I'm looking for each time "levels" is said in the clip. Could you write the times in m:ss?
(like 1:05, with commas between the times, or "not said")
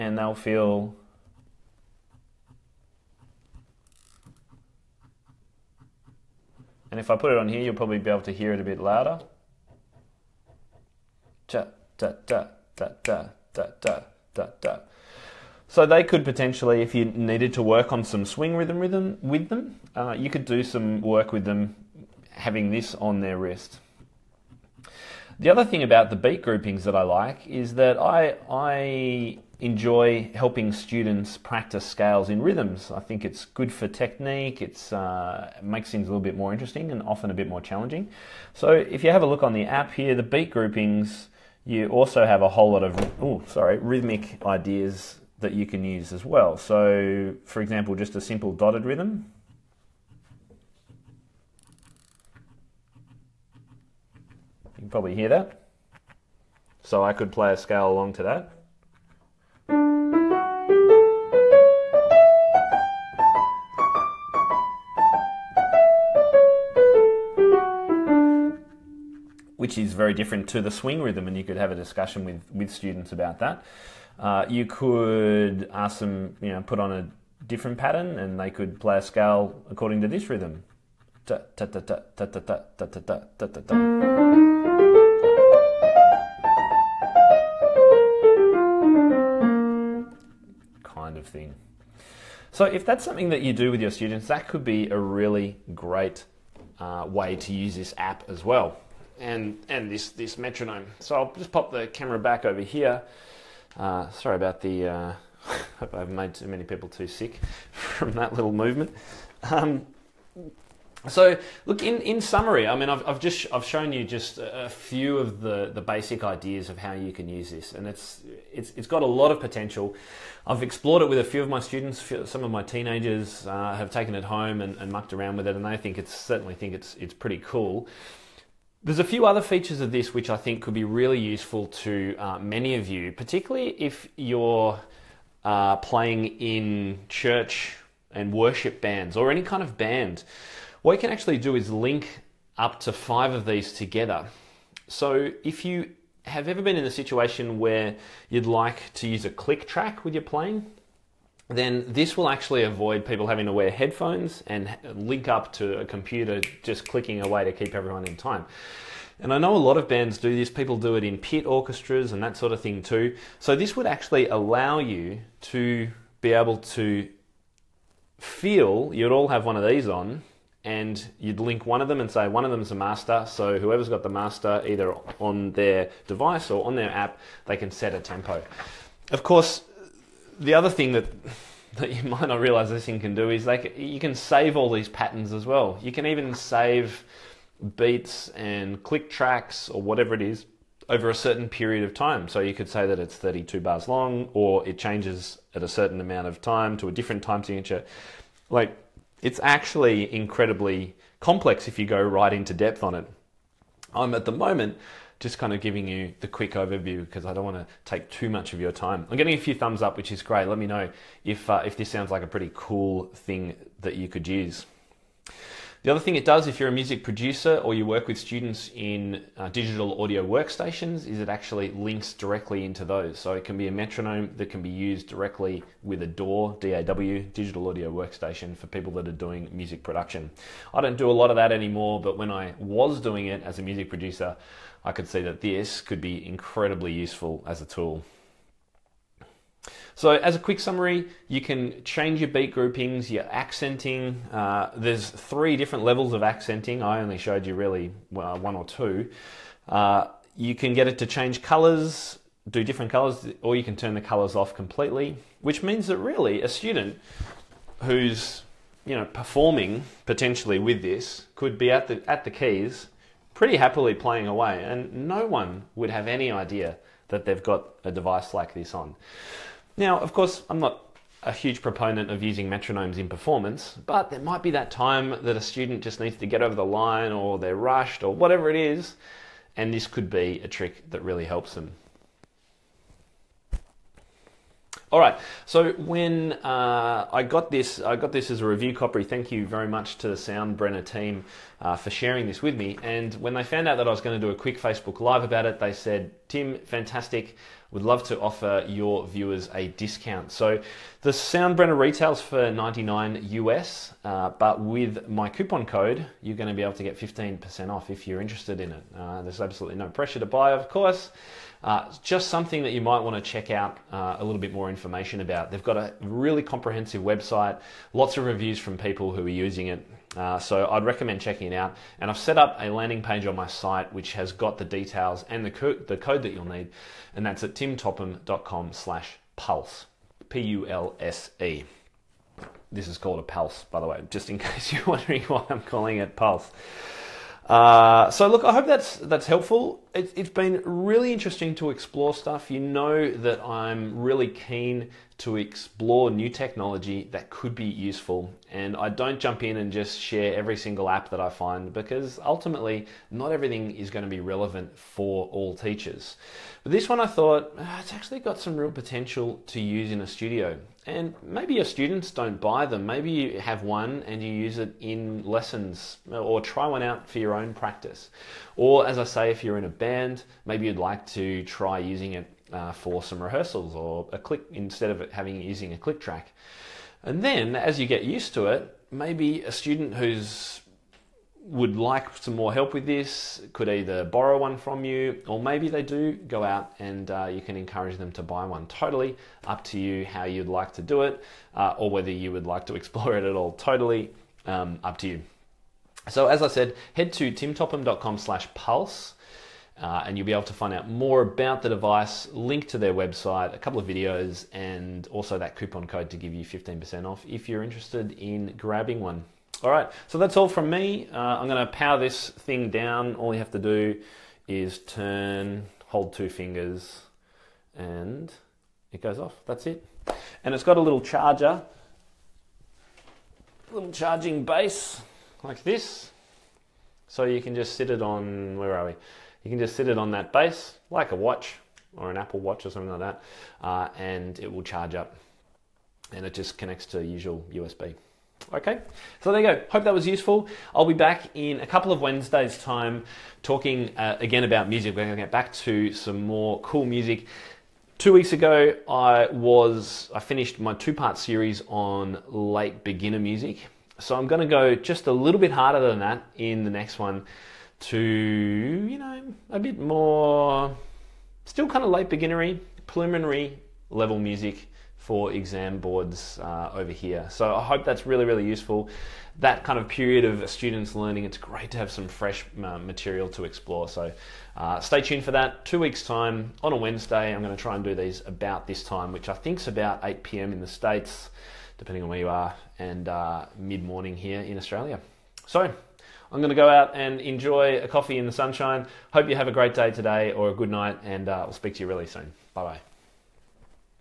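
4:05, 7:43.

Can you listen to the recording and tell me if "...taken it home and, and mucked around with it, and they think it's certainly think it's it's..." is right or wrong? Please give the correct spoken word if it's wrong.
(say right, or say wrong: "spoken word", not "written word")
right.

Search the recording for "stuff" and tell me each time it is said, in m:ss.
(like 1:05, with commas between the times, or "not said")
5:42.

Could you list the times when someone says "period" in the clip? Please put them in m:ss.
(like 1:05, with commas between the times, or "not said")
3:11, 7:49.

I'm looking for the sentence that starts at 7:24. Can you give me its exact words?
We're going to get back to some more cool music.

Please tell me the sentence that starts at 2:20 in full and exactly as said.
What you can actually do is link up to five of these together.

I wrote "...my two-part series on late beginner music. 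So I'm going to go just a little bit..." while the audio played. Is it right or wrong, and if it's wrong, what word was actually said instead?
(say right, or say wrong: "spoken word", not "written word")
right.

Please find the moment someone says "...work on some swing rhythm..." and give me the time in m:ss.
0:17.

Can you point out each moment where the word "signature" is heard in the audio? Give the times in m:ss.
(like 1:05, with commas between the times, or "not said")
3:17.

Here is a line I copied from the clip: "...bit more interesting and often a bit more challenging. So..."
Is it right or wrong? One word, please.
right.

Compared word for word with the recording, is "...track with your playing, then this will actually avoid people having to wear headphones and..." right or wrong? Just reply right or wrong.
right.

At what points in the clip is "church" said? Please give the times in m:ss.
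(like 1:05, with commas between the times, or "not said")
2:17.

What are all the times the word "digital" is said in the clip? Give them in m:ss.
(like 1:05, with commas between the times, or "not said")
3:39, 3:47.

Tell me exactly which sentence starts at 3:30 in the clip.
Let me know if, uh, if this sounds like a pretty cool thing that you could use.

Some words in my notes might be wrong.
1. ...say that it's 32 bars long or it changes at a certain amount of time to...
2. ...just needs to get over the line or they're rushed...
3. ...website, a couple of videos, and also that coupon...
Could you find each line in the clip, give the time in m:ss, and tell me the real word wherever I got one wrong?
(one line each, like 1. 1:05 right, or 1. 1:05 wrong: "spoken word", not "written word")
1. 3:12 right
2. 4:35 right
3. 6:42 right.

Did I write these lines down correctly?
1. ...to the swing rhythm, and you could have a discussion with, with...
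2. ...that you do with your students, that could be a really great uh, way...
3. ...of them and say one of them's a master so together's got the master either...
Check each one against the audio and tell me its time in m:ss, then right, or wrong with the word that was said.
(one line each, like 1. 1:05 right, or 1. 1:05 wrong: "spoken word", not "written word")
1. 1:10 right
2. 1:33 right
3. 2:51 wrong: "whoever", not "together".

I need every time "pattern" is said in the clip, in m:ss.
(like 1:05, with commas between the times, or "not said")
1:17, 3:04.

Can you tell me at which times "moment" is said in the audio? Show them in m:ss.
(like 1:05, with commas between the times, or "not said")
3:24.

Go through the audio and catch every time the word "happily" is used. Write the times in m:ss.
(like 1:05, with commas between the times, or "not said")
4:23.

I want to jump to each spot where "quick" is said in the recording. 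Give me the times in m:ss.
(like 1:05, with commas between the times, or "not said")
3:26, 4:00, 4:54.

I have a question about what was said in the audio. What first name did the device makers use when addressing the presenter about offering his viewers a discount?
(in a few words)
Tim.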